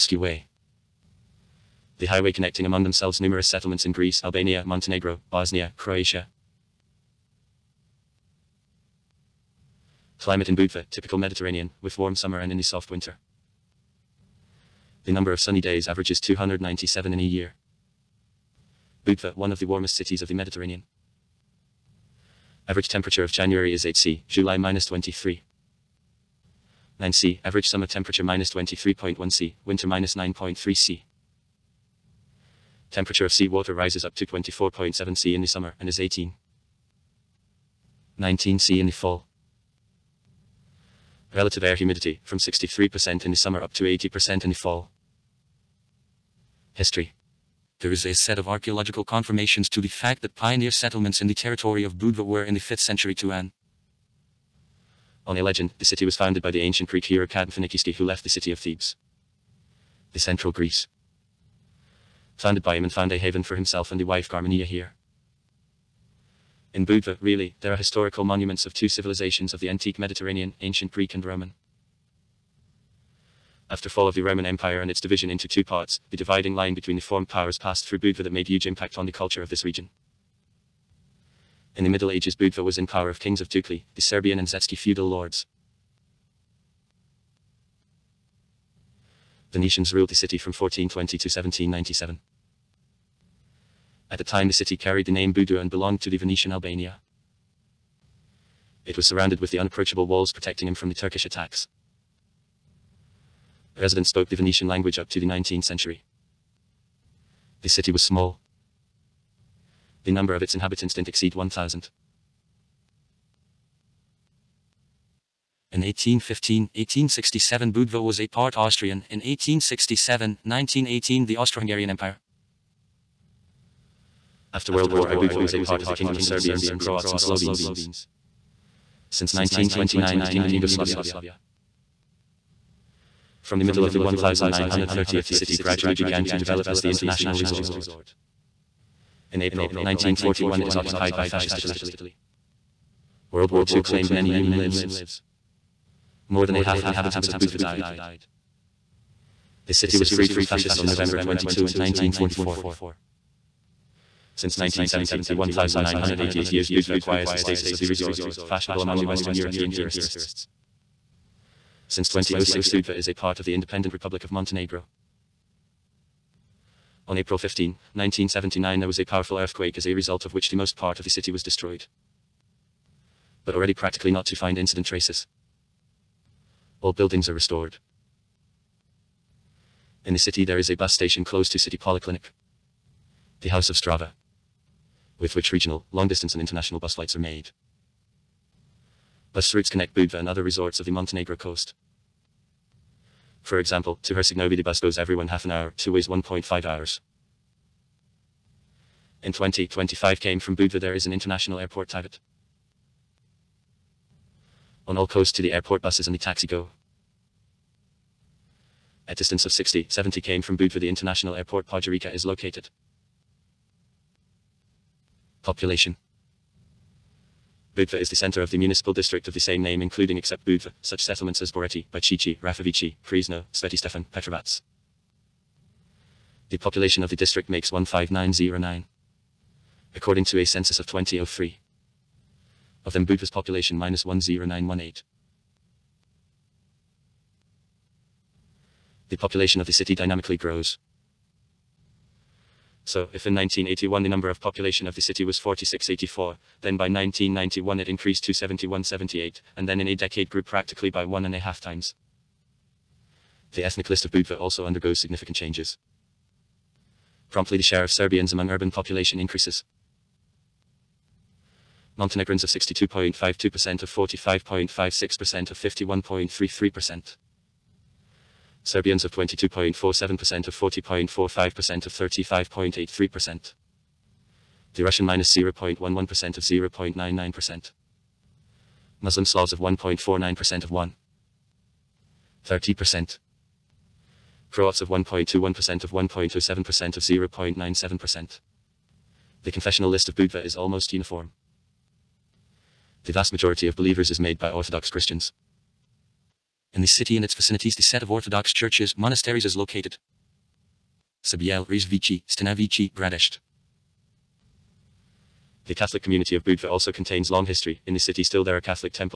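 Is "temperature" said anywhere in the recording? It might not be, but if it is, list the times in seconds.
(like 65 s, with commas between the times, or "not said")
22 s, 27 s, 32 s.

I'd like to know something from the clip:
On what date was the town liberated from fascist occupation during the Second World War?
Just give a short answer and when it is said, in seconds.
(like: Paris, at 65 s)
November 22, 1944, at 150 s.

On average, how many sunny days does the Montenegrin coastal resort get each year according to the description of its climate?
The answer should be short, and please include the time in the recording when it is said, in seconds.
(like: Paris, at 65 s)
297, at 16 s.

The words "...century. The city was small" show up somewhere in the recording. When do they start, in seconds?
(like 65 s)
105 s.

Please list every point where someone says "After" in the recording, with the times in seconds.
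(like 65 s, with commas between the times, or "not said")
73 s, 124 s.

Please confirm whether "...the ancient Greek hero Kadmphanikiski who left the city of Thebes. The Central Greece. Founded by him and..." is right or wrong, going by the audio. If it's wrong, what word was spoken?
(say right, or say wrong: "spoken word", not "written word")
right.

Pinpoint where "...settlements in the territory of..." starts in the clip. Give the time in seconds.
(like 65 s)
50 s.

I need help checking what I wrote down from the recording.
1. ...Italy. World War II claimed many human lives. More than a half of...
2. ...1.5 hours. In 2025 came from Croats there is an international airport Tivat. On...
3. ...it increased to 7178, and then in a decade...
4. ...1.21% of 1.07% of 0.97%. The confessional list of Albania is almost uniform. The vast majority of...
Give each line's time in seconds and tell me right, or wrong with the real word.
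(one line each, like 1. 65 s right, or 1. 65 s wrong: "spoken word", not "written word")
1. 141 s right
2. 196 s wrong: "Budva", not "Croats"
3. 247 s right
4. 284 s wrong: "Budva", not "Albania".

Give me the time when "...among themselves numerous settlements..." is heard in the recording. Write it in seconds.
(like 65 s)
2 s.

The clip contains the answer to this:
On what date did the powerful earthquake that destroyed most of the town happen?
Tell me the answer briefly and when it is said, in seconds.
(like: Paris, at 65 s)
April 15, 1979, at 167 s.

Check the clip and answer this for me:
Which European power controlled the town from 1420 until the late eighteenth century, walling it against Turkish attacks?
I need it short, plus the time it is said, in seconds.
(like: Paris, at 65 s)
Venetians, at 89 s.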